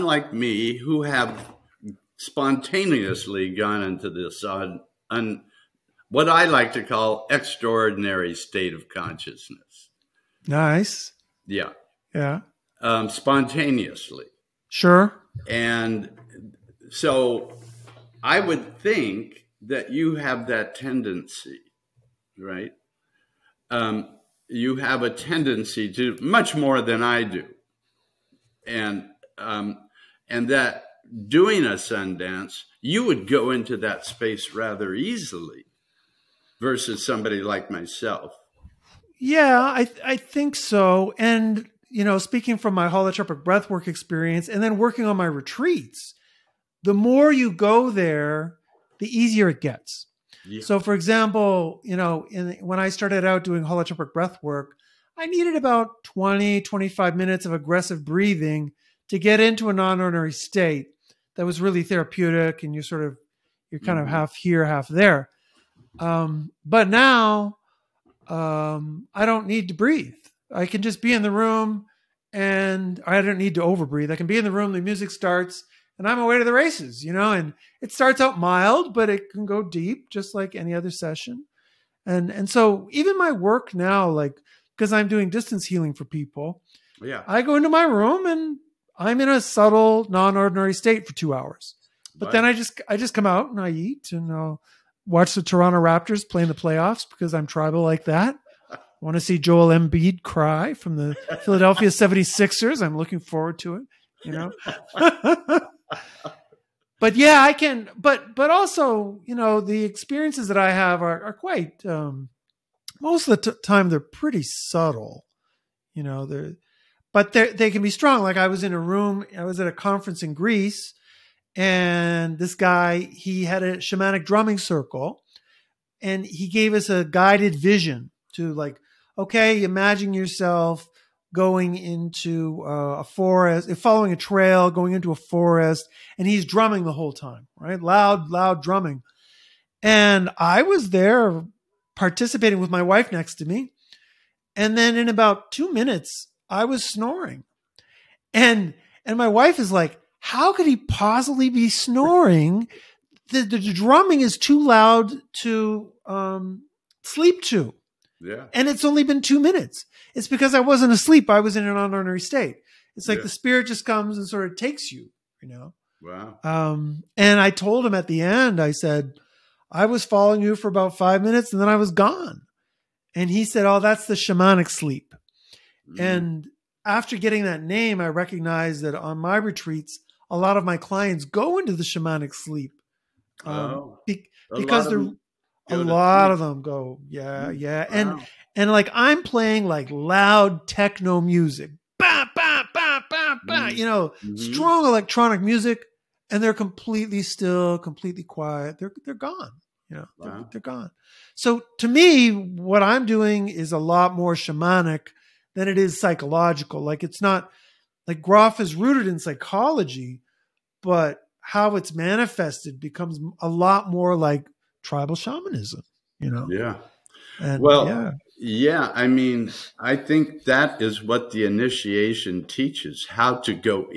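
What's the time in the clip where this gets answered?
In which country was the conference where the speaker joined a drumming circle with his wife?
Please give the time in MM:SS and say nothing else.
02:00.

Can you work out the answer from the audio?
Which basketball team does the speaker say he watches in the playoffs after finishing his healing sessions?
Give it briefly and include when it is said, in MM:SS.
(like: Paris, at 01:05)
Toronto Raptors, at 01:35.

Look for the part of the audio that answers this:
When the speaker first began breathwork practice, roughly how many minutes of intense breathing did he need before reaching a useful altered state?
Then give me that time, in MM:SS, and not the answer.
00:56.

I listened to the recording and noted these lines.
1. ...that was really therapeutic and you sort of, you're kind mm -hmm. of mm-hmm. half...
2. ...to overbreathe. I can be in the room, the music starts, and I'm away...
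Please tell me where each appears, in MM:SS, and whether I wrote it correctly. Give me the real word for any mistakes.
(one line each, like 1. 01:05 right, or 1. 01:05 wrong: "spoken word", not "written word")
1. 01:01 right
2. 01:13 right.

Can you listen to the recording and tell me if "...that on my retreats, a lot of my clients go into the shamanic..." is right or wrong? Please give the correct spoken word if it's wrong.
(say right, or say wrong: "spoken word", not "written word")
right.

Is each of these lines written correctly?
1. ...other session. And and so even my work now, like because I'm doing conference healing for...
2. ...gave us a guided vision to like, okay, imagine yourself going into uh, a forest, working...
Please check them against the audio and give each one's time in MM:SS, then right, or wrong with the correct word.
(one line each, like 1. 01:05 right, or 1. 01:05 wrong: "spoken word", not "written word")
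1. 01:20 wrong: "distance", not "conference"
2. 02:06 wrong: "following", not "working".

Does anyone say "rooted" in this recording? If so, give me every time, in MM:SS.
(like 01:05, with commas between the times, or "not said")
03:28.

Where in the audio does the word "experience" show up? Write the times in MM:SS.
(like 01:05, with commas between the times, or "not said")
00:43, 01:49.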